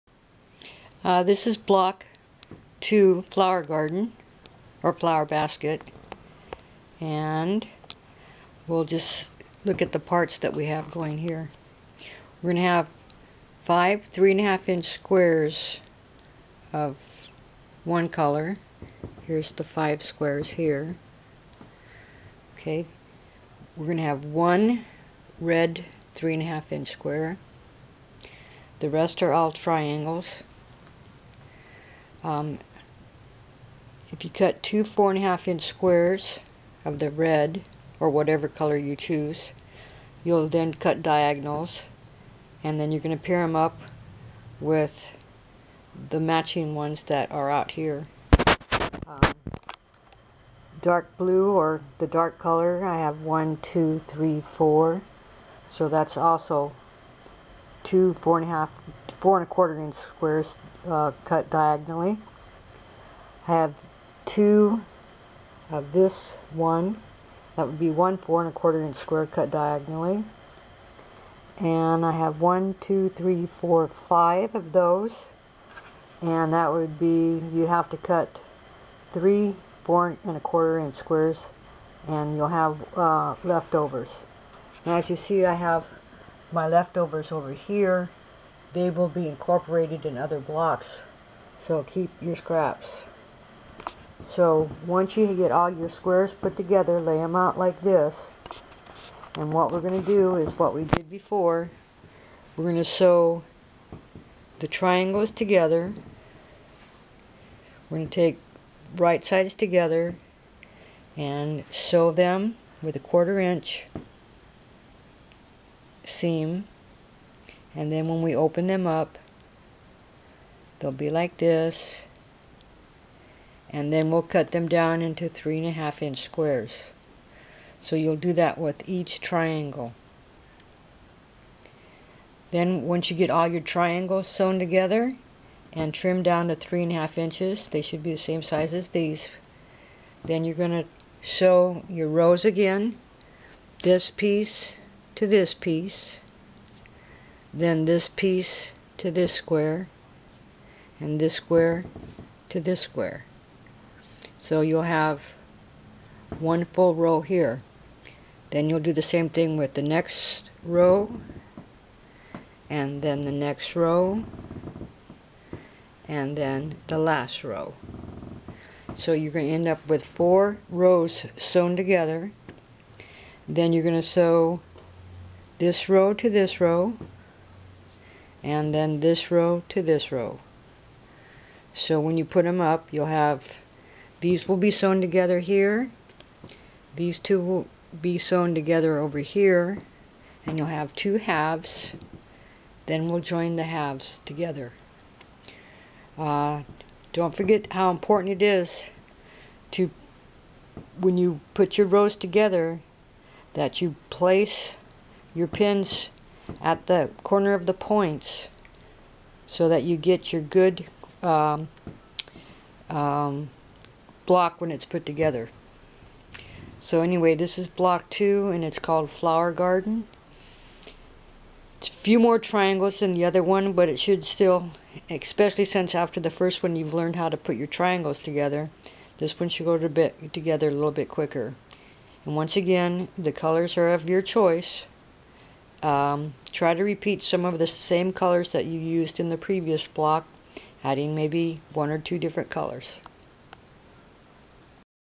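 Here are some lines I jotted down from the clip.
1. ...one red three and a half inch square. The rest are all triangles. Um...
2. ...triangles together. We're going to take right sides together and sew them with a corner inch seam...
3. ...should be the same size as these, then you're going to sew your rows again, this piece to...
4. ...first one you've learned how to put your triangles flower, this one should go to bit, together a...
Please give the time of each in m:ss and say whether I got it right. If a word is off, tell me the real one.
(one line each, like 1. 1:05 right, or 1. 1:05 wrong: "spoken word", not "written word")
1. 0:24 right
2. 1:44 wrong: "quarter", not "corner"
3. 2:17 right
4. 3:46 wrong: "together", not "flower".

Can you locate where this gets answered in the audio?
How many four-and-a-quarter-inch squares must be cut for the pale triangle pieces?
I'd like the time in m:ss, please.
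1:19.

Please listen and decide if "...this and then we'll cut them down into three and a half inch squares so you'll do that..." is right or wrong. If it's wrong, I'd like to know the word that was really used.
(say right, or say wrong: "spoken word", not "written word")
right.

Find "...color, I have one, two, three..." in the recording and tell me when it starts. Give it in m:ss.
0:52.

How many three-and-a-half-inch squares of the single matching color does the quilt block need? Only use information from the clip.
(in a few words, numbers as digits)
5.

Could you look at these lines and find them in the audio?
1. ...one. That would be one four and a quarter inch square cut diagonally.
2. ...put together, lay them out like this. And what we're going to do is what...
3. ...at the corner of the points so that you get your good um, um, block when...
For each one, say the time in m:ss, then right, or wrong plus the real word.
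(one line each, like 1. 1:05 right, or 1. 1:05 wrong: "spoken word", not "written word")
1. 1:06 right
2. 1:36 right
3. 3:26 right.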